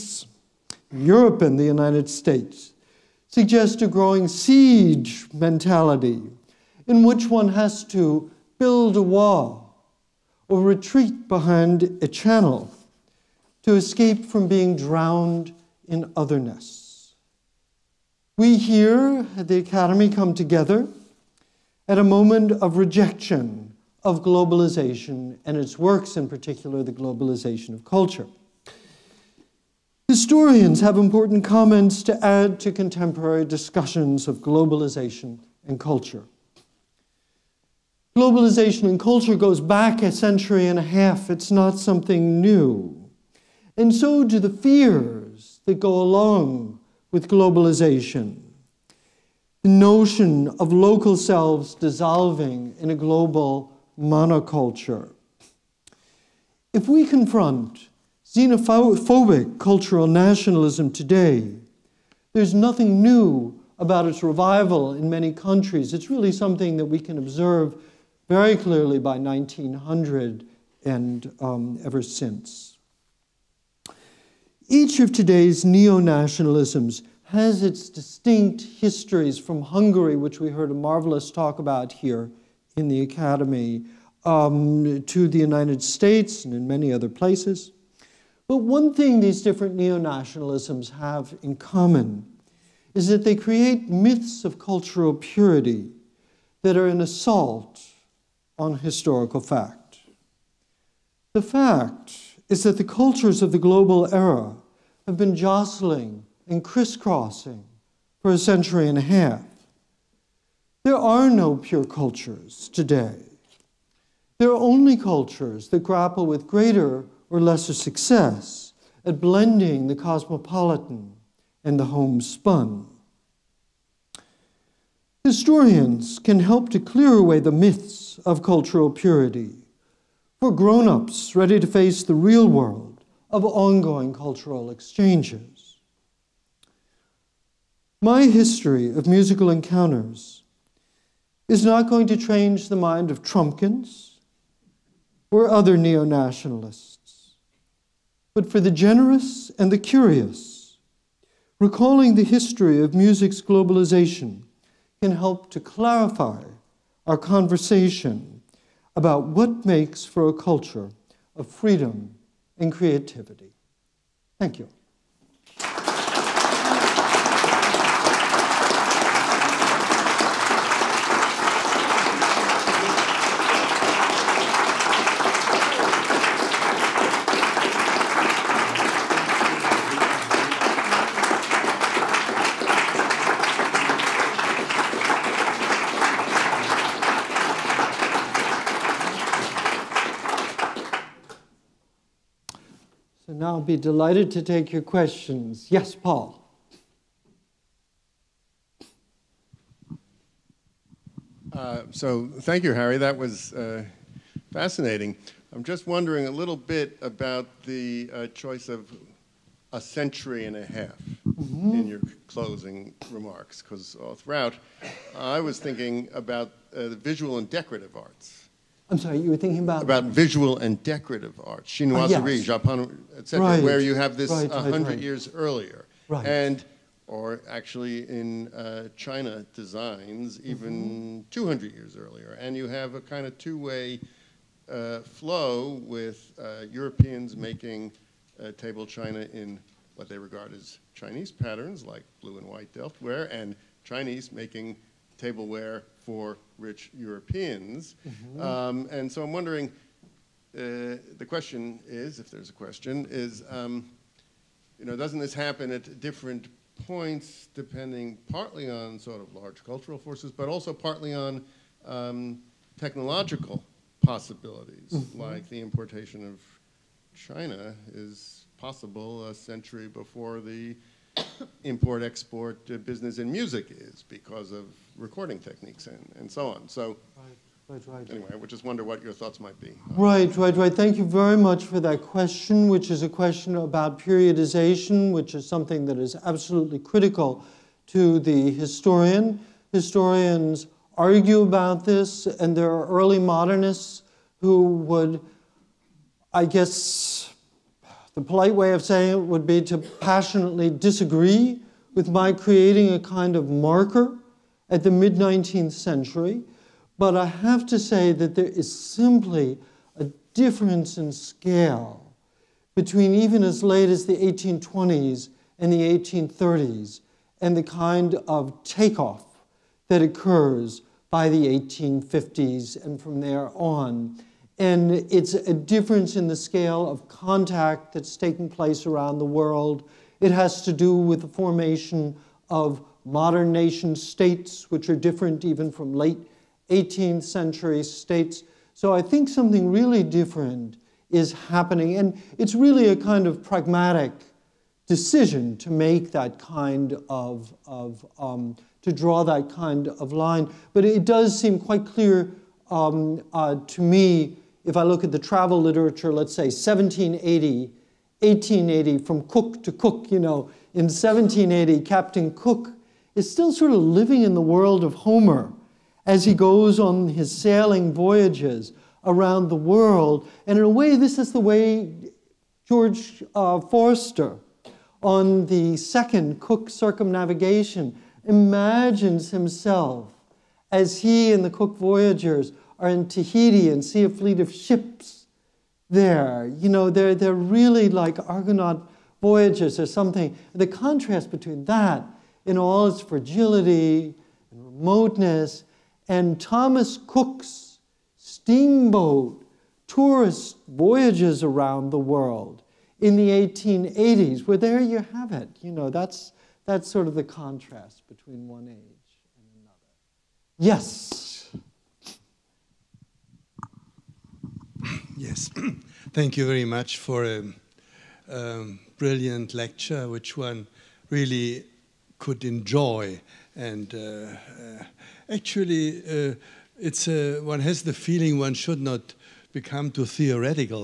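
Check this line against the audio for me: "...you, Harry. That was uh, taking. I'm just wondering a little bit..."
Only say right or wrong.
wrong.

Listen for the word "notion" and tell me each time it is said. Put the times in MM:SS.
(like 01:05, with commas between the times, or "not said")
00:49.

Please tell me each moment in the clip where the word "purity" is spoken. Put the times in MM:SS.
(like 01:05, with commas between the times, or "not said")
01:35, 02:08.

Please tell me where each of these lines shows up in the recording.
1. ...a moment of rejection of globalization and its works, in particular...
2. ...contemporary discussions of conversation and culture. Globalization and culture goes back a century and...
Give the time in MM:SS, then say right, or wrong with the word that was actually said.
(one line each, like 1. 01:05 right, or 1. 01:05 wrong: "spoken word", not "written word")
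1. 00:21 right
2. 00:32 wrong: "globalization", not "conversation".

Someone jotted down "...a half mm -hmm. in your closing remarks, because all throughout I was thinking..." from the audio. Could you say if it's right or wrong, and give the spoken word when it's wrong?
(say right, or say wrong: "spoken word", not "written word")
right.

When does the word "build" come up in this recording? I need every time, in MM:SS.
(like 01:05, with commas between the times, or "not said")
00:08.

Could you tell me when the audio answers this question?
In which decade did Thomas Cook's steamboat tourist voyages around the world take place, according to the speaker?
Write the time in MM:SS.
06:43.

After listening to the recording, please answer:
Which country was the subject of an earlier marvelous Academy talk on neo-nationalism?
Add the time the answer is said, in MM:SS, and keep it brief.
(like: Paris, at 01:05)
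Hungary, at 01:19.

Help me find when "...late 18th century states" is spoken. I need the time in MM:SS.
05:35.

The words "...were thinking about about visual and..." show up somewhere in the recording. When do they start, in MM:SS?
03:39.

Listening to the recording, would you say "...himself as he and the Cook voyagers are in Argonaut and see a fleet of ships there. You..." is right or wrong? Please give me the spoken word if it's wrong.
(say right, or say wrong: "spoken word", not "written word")
wrong: "Tahiti", not "Argonaut".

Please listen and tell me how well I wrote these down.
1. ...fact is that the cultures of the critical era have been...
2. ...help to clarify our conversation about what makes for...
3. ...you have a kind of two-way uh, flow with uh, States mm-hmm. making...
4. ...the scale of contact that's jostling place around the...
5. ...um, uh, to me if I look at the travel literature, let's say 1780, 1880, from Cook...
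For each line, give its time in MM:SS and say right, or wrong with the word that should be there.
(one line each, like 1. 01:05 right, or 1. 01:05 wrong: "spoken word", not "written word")
1. 01:41 wrong: "global", not "critical"
2. 02:35 right
3. 03:52 wrong: "Europeans", not "States"
4. 05:26 wrong: "taking", not "jostling"
5. 05:52 right.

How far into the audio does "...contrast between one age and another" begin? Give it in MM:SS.
06:47.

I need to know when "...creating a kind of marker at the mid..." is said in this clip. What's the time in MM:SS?
05:02.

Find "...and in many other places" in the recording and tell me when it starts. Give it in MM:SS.
01:26.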